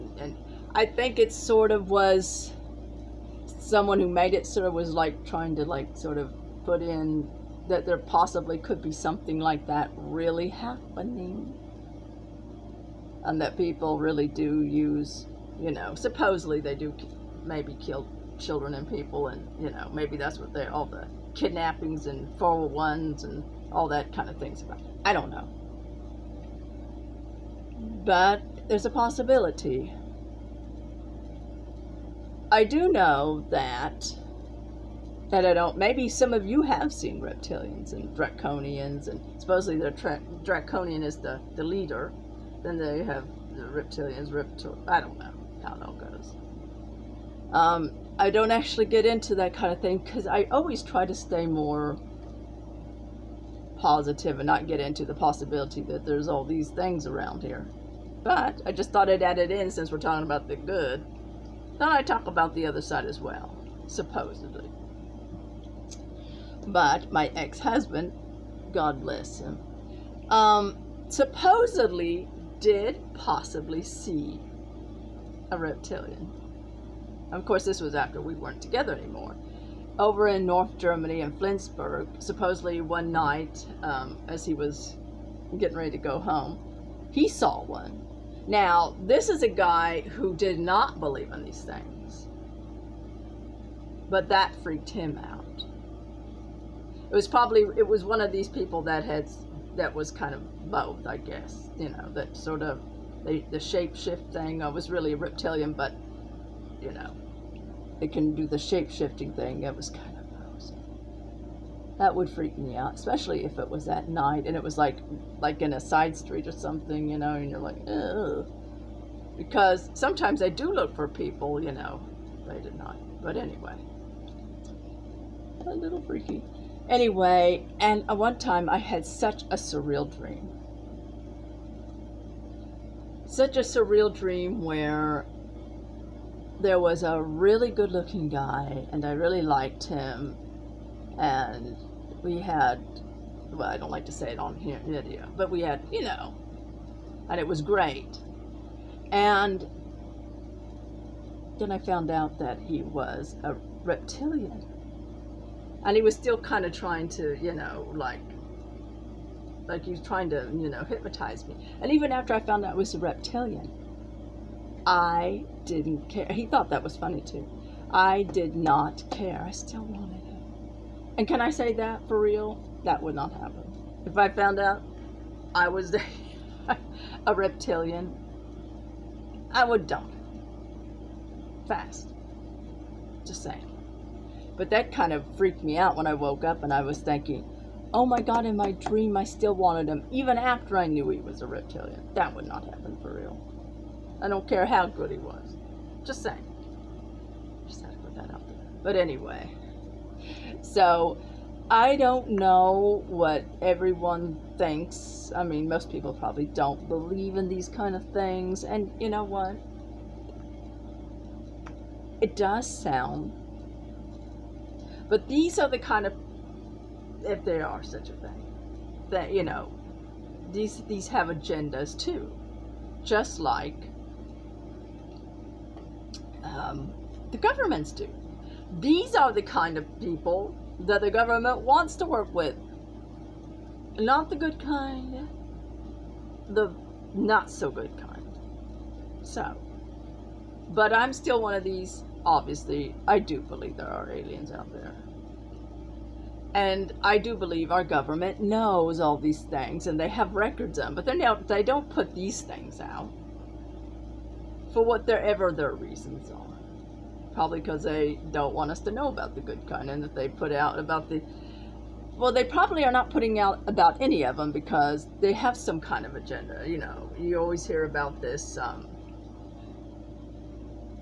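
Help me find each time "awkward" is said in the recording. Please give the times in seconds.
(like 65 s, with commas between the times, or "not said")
not said.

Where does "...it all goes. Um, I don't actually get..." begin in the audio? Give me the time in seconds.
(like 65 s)
45 s.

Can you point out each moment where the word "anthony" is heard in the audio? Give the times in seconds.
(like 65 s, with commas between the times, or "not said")
not said.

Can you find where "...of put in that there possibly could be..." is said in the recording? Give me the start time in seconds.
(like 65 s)
6 s.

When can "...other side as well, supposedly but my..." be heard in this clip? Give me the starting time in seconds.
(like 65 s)
62 s.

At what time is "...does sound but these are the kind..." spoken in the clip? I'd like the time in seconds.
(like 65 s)
212 s.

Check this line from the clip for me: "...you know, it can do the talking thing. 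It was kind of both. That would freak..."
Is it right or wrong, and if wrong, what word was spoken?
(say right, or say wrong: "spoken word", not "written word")
wrong: "shapeshifting", not "talking".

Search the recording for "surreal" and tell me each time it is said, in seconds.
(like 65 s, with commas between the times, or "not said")
129 s, 133 s.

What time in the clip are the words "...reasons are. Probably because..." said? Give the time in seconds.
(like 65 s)
255 s.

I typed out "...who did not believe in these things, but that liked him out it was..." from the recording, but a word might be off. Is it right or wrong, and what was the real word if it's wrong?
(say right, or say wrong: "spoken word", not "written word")
wrong: "freaked", not "liked".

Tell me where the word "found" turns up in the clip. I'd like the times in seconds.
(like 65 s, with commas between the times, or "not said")
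151 s, 162 s, 174 s.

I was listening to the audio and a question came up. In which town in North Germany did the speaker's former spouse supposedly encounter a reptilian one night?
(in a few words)
Flensburg.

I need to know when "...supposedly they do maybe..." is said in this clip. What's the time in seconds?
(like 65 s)
15 s.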